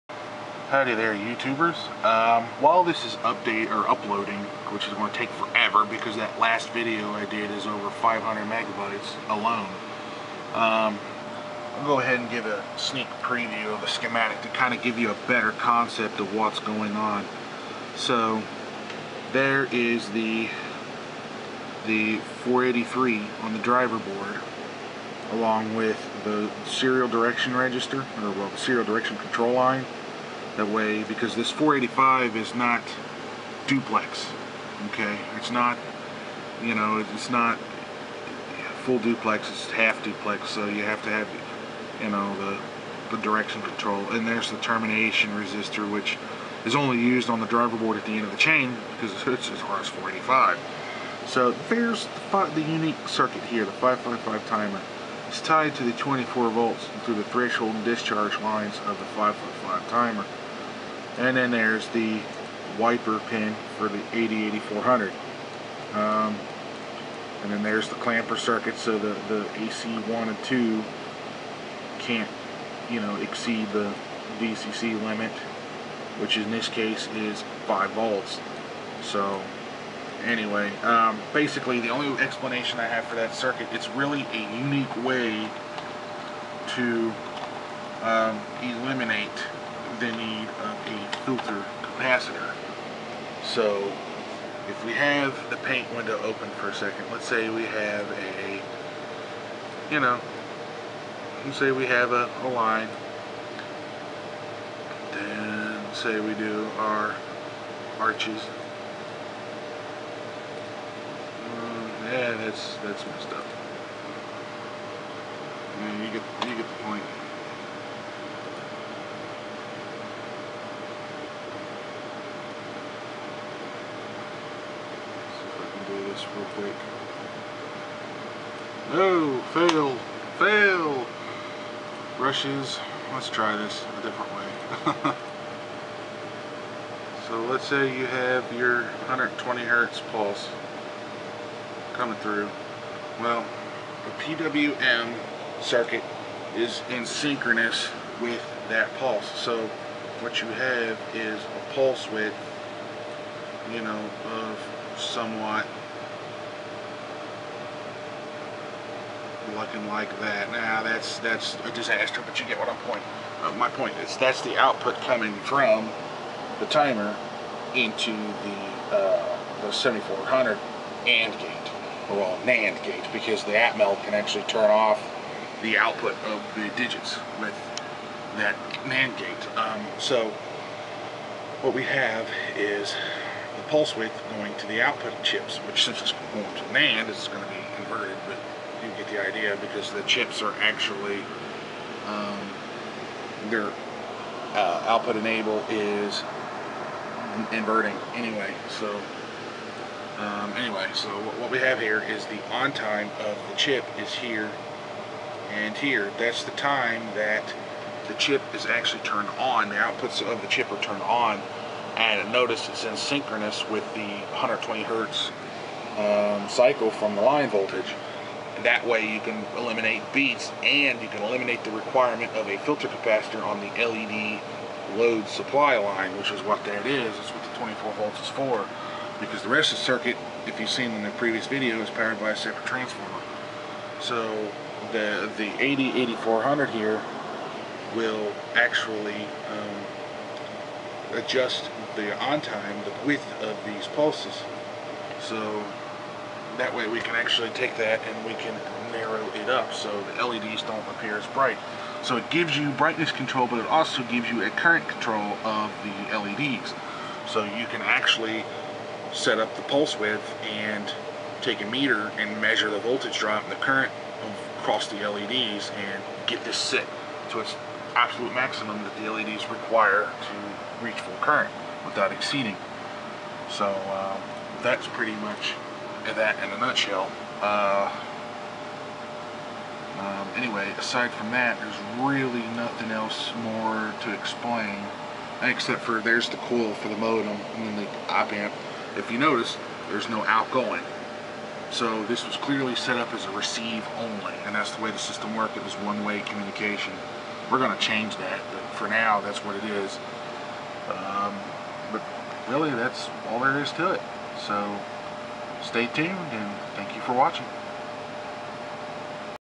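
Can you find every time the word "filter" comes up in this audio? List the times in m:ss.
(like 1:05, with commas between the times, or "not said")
1:31, 3:42.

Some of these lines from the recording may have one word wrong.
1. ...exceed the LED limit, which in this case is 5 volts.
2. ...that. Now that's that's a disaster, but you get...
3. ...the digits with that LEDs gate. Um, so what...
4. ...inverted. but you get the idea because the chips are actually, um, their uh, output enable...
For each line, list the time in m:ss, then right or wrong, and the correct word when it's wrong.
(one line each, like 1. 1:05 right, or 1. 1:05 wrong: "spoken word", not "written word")
1. 1:13 wrong: "VCC", not "LED"
2. 2:40 right
3. 2:56 wrong: "NAND", not "LEDs"
4. 3:07 right.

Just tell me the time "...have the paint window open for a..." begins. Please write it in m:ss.
1:34.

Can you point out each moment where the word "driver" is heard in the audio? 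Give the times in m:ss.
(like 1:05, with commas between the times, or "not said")
0:23, 0:47.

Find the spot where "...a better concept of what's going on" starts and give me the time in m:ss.
0:15.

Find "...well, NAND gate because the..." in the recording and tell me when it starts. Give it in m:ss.
2:52.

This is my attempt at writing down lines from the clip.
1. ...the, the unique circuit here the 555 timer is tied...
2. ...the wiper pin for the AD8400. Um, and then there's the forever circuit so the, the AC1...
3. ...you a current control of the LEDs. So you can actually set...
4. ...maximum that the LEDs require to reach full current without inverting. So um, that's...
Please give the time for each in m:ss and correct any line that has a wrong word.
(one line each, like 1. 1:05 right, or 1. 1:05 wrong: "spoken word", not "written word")
1. 0:52 right
2. 1:01 wrong: "clamper", not "forever"
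3. 4:14 right
4. 4:28 wrong: "exceeding", not "inverting".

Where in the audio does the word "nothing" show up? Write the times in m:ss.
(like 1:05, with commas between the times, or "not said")
4:42.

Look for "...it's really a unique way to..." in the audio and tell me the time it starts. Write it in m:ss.
1:23.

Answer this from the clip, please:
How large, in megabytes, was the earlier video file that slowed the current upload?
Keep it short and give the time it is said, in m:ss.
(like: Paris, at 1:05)
over 500 megabytes, at 0:07.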